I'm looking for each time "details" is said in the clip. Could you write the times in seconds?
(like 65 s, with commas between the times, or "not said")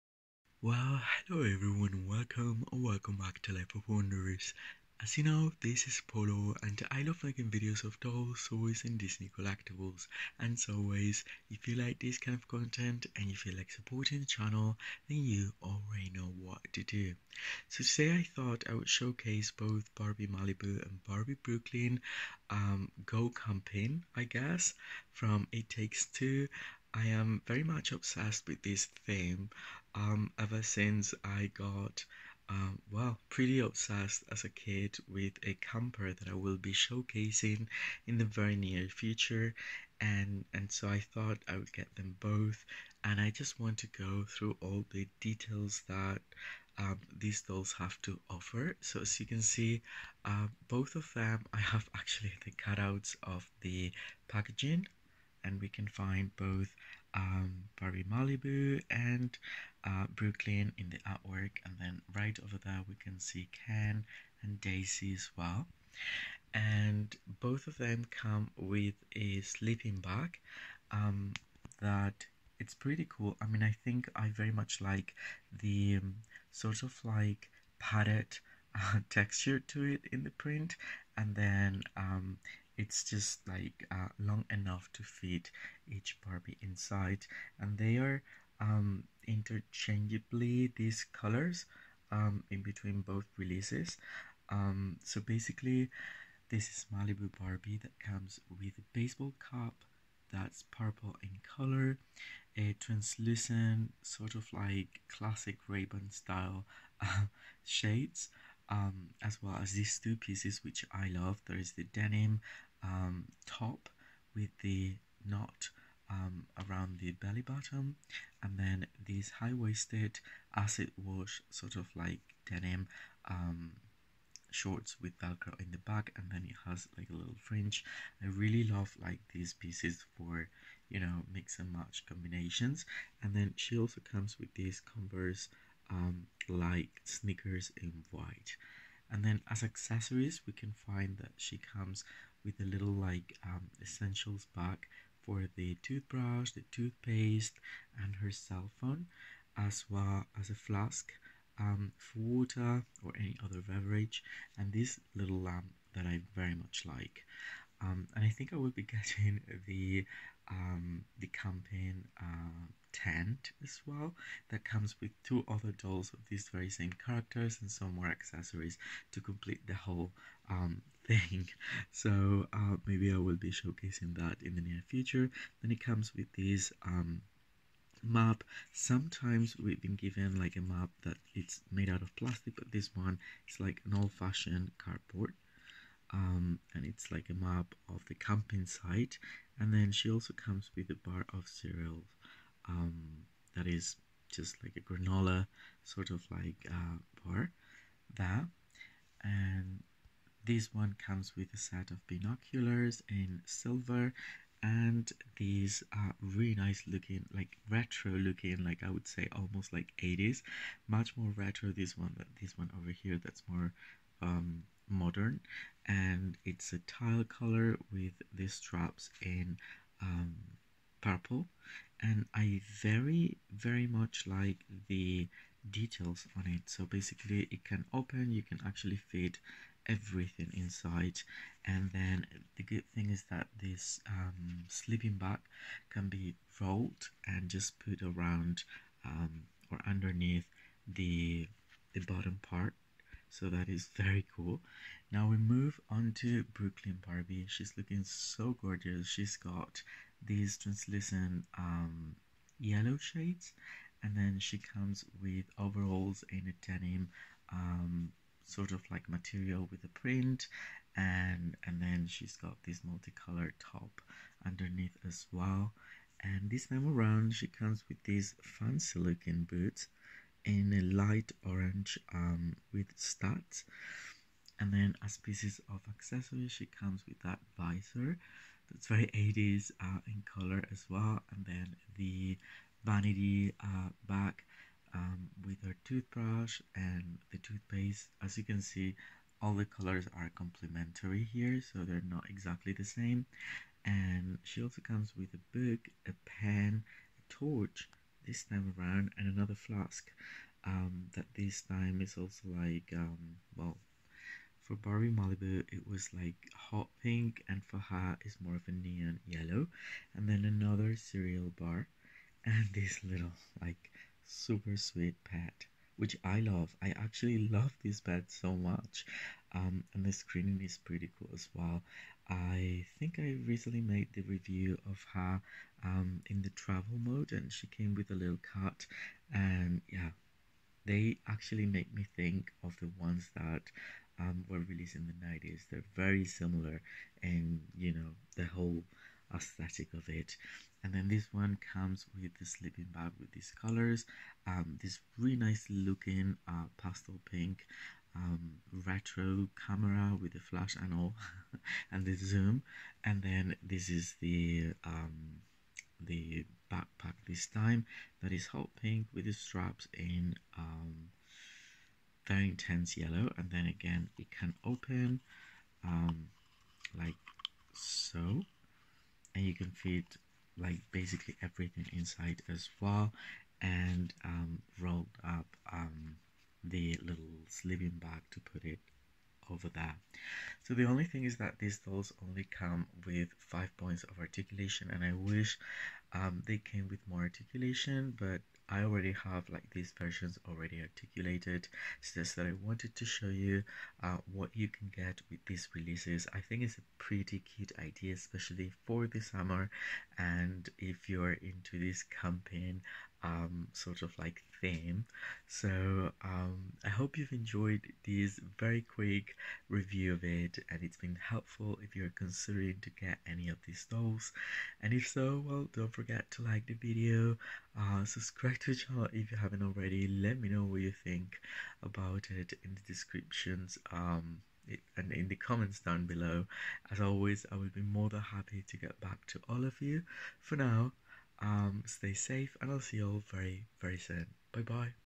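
45 s, 225 s.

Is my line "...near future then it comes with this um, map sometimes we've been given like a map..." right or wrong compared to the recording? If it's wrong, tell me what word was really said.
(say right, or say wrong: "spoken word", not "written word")
right.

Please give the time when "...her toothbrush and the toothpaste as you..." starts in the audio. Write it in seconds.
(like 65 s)
285 s.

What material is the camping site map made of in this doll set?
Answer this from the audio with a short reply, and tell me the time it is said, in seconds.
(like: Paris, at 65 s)
Cardboard, at 184 s.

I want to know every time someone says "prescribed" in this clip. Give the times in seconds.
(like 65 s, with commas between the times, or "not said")
not said.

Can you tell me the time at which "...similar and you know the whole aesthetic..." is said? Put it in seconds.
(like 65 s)
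336 s.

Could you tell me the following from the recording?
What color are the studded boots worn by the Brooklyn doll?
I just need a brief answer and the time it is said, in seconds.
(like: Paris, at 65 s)
Light orange, at 270 s.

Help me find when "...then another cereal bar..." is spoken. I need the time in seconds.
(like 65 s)
310 s.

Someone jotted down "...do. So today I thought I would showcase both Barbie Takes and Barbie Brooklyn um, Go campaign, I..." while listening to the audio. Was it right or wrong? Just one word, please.
wrong.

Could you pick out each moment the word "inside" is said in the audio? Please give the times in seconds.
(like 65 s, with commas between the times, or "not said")
86 s, 230 s, 371 s.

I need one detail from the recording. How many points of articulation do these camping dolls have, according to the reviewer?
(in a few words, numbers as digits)
5.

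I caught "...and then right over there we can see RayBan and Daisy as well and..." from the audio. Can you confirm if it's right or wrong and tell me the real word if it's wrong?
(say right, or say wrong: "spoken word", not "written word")
wrong: "Ken", not "RayBan".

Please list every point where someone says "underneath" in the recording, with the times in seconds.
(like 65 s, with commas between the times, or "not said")
239 s, 264 s.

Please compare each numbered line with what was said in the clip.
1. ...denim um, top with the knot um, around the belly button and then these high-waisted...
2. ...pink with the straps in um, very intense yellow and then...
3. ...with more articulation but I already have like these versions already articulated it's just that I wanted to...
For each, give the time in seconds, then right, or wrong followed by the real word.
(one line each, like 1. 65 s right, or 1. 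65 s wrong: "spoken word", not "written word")
1. 111 s right
2. 358 s right
3. 386 s right.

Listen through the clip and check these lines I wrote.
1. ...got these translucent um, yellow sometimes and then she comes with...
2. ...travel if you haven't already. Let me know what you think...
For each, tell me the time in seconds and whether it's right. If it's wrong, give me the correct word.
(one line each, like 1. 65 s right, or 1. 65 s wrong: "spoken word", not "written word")
1. 249 s wrong: "shades", not "sometimes"
2. 418 s wrong: "channel", not "travel".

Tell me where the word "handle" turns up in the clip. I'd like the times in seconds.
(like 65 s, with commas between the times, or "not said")
not said.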